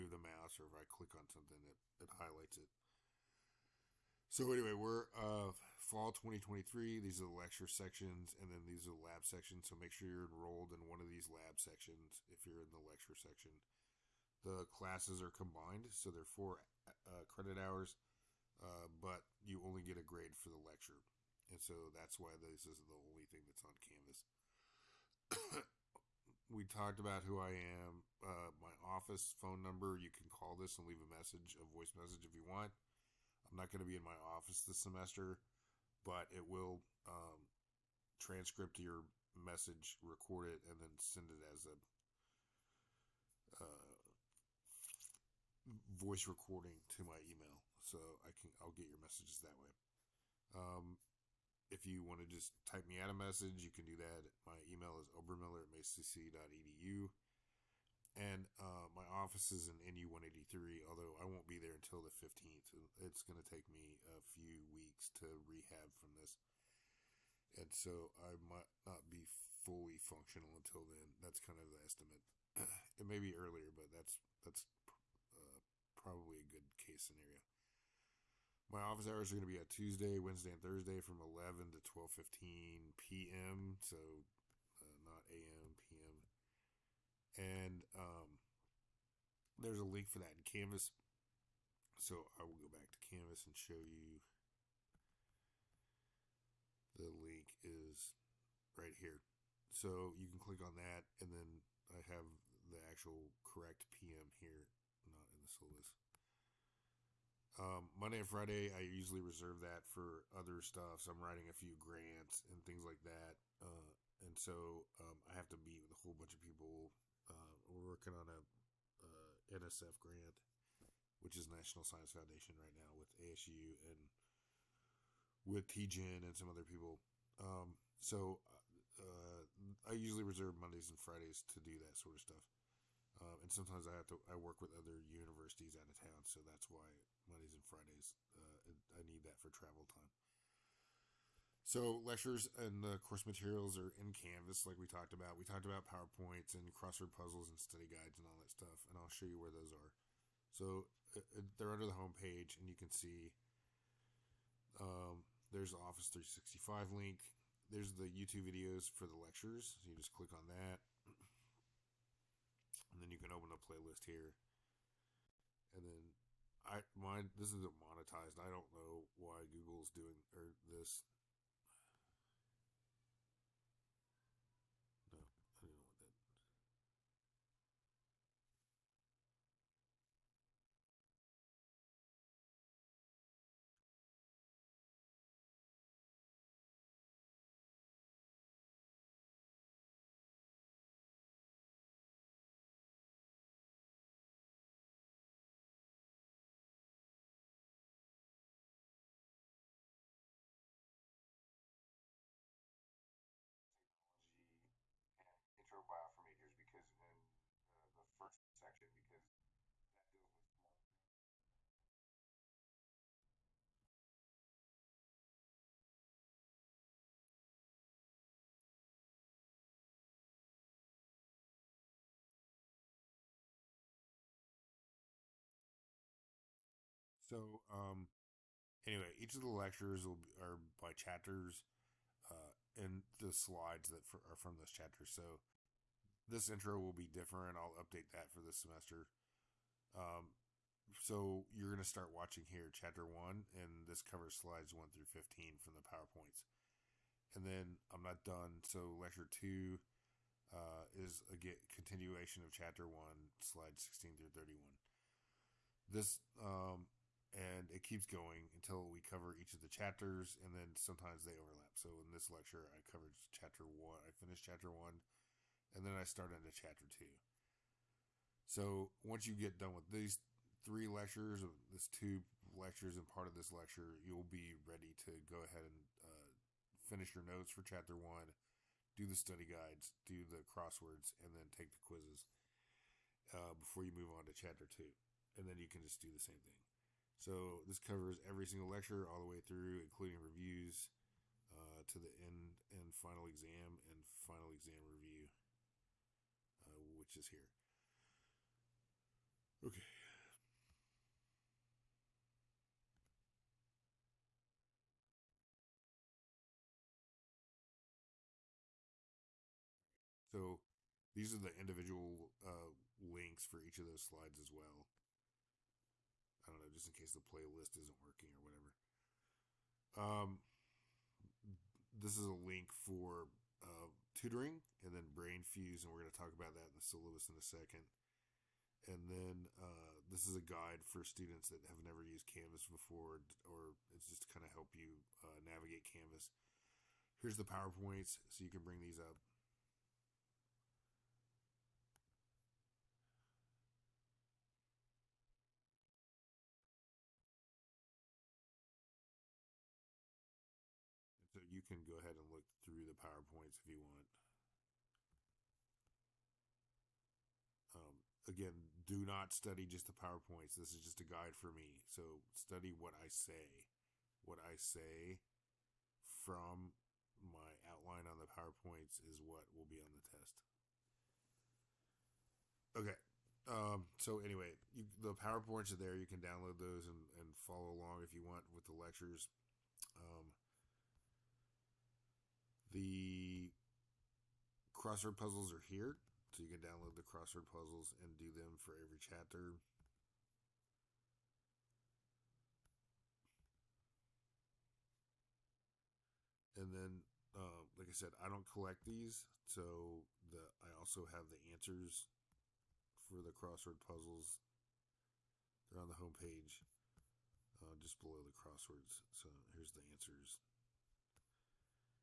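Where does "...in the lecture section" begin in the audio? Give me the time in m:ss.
0:12.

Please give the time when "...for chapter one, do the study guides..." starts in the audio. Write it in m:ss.
4:37.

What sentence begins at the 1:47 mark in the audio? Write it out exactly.
Um, Monday and Friday, I usually reserve that for other stuff.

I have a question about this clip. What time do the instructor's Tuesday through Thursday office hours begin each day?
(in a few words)
11.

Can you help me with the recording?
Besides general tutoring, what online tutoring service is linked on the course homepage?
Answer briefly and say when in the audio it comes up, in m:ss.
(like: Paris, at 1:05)
Brainfuse, at 5:25.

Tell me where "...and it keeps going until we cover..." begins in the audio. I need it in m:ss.
4:17.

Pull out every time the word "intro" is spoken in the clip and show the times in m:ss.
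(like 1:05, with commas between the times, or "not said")
3:25, 3:56.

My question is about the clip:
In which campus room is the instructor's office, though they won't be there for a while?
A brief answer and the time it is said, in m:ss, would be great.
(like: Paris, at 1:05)
NU 183, at 0:59.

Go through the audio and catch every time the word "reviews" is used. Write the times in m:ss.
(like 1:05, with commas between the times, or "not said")
4:50, 4:54.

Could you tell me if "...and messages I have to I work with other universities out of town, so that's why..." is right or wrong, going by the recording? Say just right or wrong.
wrong.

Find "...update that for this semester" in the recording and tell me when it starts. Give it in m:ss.
3:57.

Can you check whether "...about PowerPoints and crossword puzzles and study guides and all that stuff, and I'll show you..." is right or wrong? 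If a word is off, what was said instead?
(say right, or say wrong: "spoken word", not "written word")
right.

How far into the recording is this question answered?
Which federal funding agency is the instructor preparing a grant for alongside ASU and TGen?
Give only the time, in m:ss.
2:01.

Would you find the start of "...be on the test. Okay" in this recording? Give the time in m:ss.
6:09.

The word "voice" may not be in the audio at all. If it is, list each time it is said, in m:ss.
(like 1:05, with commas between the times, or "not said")
0:31, 0:45.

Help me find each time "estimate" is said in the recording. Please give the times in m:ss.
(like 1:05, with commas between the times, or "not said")
1:11.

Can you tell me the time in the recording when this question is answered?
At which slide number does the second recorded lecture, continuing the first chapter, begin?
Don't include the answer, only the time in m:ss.
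4:13.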